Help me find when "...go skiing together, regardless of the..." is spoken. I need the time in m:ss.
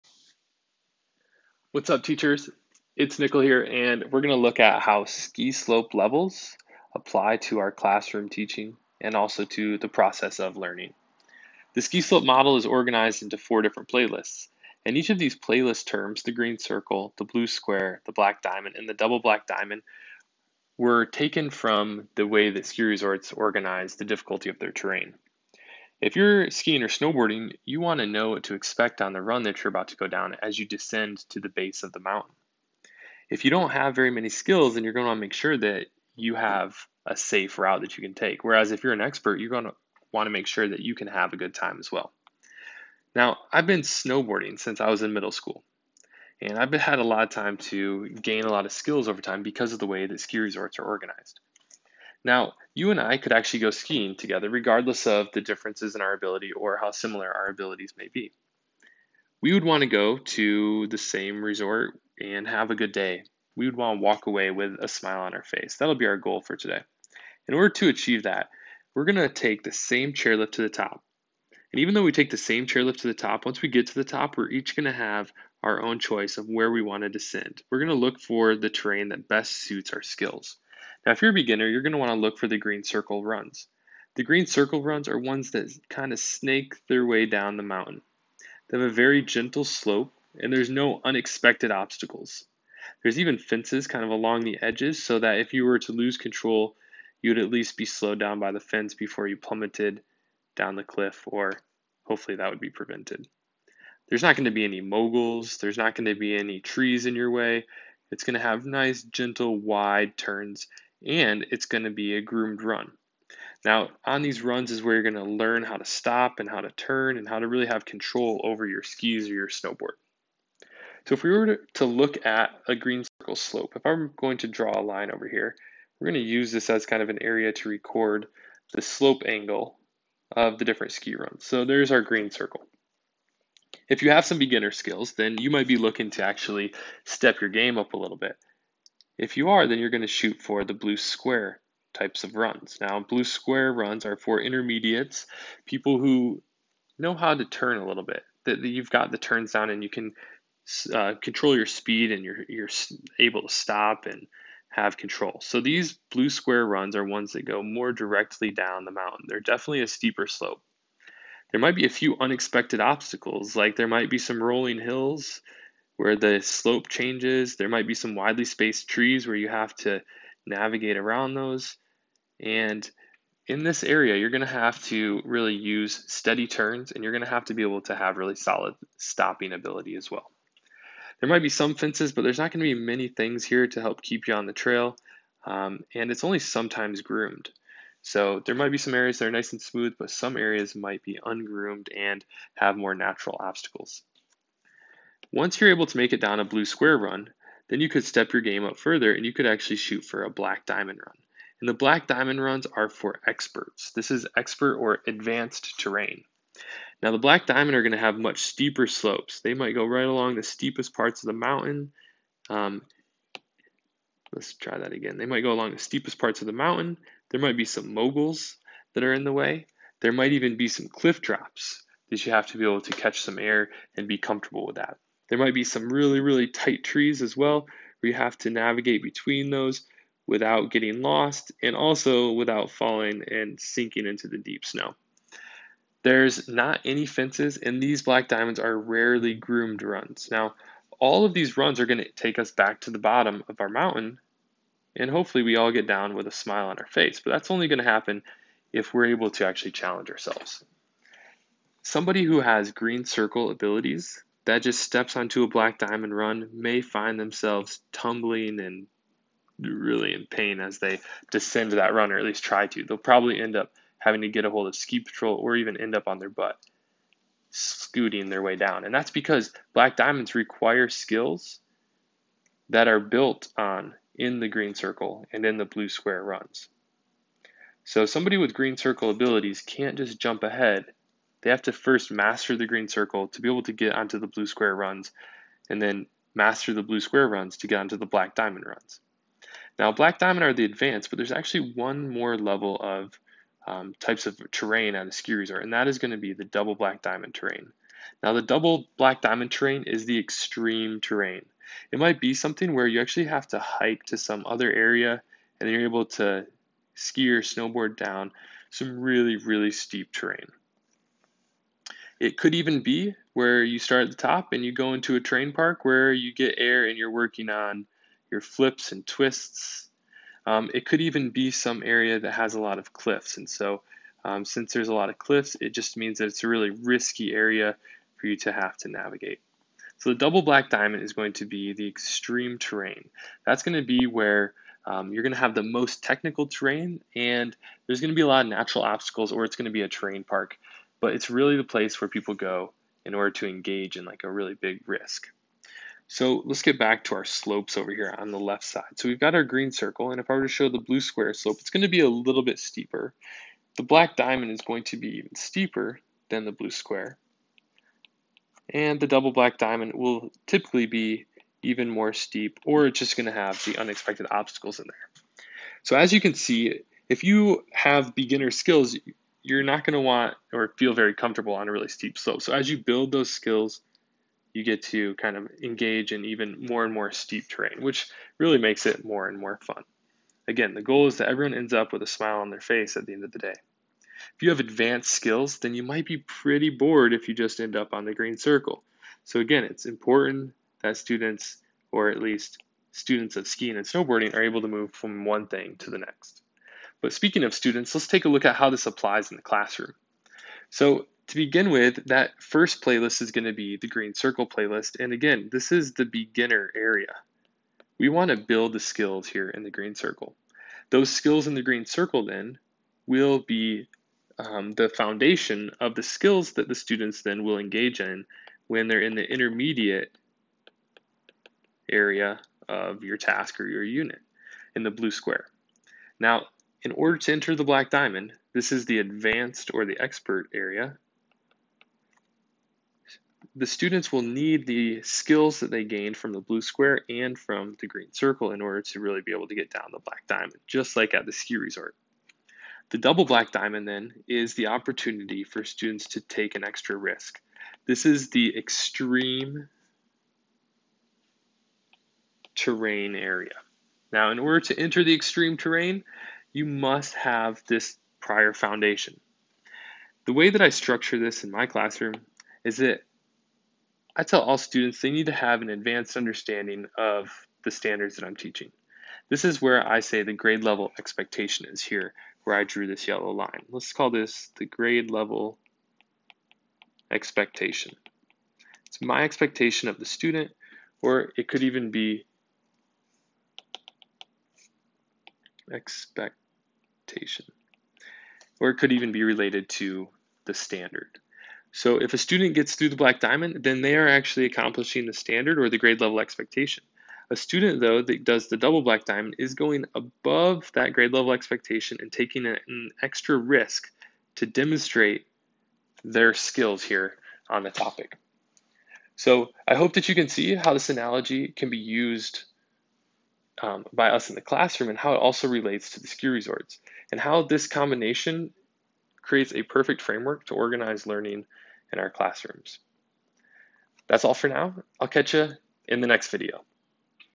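0:53.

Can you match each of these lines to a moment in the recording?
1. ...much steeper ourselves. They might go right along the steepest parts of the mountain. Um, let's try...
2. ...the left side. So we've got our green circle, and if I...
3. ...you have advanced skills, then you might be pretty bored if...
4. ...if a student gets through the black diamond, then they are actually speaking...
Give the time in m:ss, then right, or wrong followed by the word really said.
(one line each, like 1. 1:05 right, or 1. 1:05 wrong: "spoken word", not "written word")
1. 3:28 wrong: "slopes", not "ourselves"
2. 5:48 right
3. 6:24 right
4. 8:12 wrong: "accomplishing", not "speaking".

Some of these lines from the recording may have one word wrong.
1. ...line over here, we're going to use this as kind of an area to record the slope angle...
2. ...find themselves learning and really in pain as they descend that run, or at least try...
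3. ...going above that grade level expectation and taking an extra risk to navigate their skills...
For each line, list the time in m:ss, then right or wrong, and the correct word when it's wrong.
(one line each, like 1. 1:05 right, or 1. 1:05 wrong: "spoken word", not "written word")
1. 2:04 right
2. 4:16 wrong: "tumbling", not "learning"
3. 8:19 wrong: "demonstrate", not "navigate".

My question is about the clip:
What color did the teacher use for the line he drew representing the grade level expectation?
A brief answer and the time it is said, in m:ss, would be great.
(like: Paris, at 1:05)
yellow, at 7:53.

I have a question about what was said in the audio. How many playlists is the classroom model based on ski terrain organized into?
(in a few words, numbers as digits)
4.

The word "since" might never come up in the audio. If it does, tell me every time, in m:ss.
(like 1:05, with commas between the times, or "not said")
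0:44, 5:24.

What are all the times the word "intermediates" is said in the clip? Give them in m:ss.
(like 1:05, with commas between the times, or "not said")
2:24, 6:59.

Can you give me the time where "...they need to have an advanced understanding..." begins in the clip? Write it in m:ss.
7:45.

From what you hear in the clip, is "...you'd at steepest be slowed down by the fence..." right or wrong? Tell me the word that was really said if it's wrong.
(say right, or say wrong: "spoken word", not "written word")
wrong: "least", not "steepest".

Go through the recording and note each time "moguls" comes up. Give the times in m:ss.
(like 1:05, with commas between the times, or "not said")
1:44, 3:37.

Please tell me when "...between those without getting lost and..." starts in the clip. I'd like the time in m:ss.
3:49.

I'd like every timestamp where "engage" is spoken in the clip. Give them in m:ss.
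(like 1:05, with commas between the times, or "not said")
5:43, 6:15, 6:57.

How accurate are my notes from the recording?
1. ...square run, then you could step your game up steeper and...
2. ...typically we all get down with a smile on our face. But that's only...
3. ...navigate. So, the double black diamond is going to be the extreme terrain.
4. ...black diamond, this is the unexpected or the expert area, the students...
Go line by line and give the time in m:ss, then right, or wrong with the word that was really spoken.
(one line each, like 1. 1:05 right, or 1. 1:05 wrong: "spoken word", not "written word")
1. 3:16 wrong: "further", not "steeper"
2. 4:05 wrong: "hopefully", not "typically"
3. 5:28 right
4. 7:07 wrong: "advanced", not "unexpected".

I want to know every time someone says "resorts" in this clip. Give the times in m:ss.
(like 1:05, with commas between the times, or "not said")
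0:22, 0:50, 1:01, 4:55, 7:21, 8:36.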